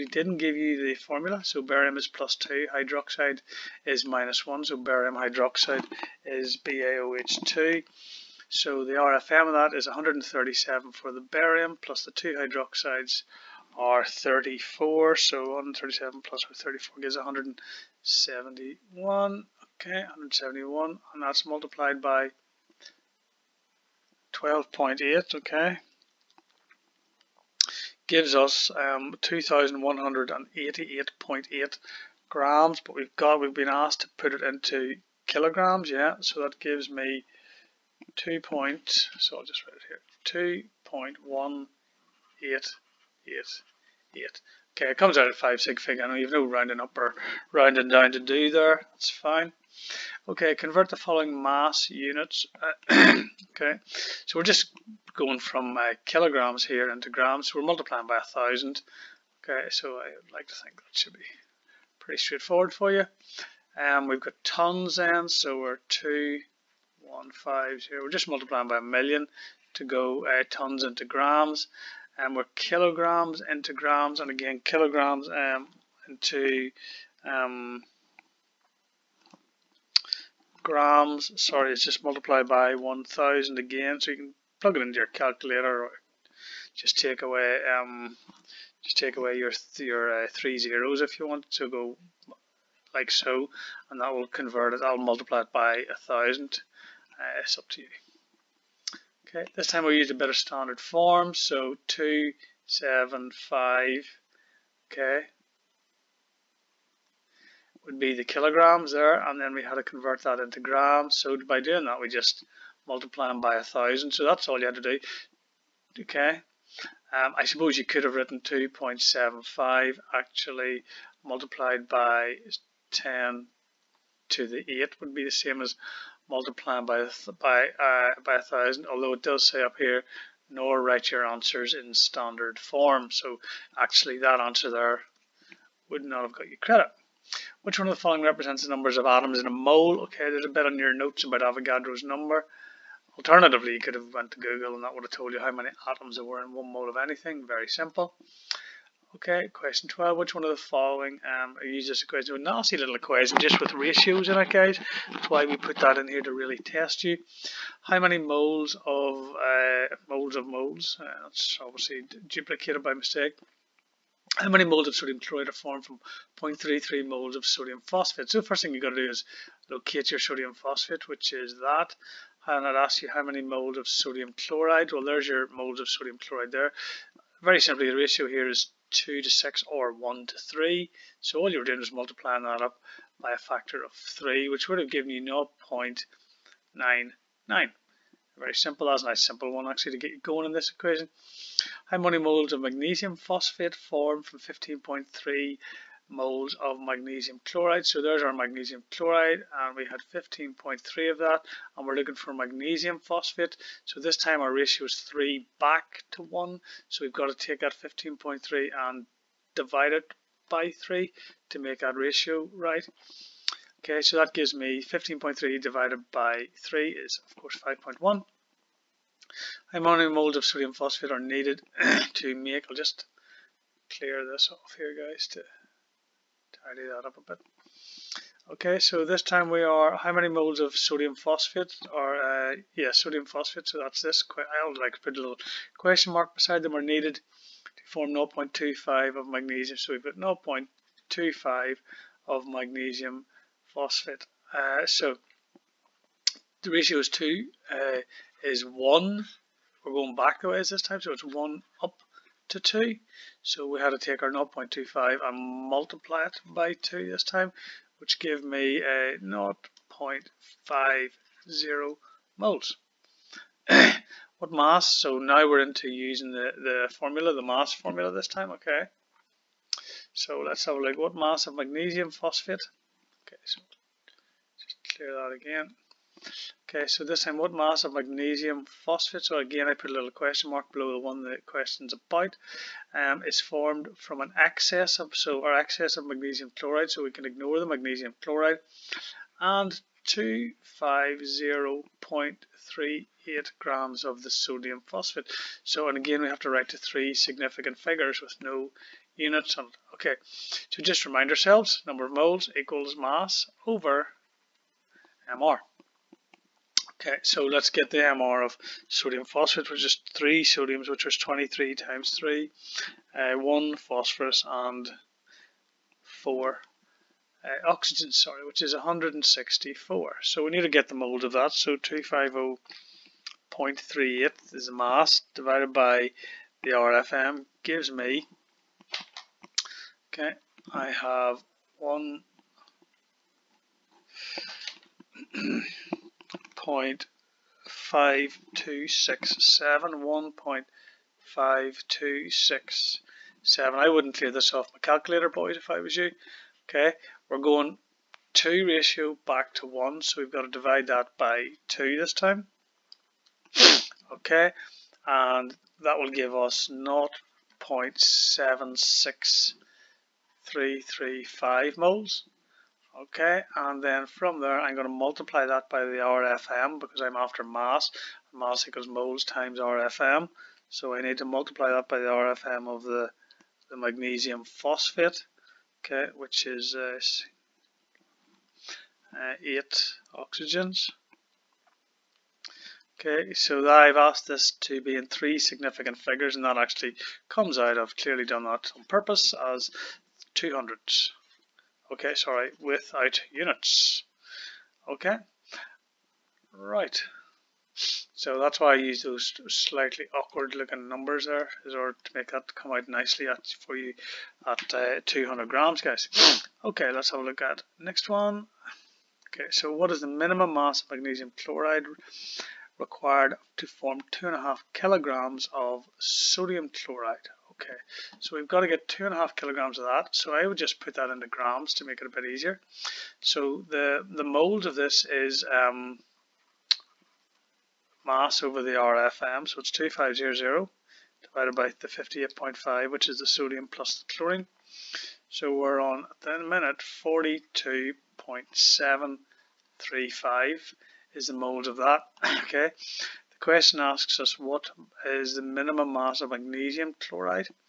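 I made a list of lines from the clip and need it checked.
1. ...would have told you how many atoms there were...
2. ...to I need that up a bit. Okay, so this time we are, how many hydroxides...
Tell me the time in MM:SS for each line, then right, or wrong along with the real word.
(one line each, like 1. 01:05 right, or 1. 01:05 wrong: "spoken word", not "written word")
1. 02:24 right
2. 03:45 wrong: "moles", not "hydroxides".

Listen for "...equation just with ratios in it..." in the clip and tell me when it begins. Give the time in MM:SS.
02:32.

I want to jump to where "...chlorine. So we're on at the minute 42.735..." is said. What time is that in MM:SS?
07:14.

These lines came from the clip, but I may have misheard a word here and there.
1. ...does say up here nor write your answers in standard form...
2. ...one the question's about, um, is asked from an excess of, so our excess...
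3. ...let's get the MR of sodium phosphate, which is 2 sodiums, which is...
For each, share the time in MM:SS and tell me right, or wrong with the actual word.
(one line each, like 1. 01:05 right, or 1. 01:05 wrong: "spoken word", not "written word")
1. 02:09 right
2. 04:40 wrong: "formed", not "asked"
3. 05:07 wrong: "3", not "2".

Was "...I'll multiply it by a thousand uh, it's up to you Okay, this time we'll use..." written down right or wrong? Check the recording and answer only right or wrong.
right.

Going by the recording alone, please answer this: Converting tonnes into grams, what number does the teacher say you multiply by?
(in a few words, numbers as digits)
a million.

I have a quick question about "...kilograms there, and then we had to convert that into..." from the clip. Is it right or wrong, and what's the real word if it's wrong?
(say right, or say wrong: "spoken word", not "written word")
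right.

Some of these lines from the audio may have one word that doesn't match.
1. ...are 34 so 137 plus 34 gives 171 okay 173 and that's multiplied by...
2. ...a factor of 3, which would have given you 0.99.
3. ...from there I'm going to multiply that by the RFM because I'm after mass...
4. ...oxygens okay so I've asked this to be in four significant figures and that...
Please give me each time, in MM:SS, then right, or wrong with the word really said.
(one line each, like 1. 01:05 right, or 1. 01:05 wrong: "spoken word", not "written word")
1. 00:13 wrong: "171", not "173"
2. 03:03 right
3. 06:04 right
4. 06:20 wrong: "three", not "four".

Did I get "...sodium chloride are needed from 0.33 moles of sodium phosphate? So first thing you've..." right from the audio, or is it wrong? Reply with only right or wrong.
wrong.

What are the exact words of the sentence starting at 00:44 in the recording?
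Okay, it comes out at 5 sig fig.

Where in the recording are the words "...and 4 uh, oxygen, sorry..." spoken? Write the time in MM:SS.
05:14.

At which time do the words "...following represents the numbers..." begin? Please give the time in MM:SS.
02:18.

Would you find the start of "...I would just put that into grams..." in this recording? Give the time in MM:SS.
07:00.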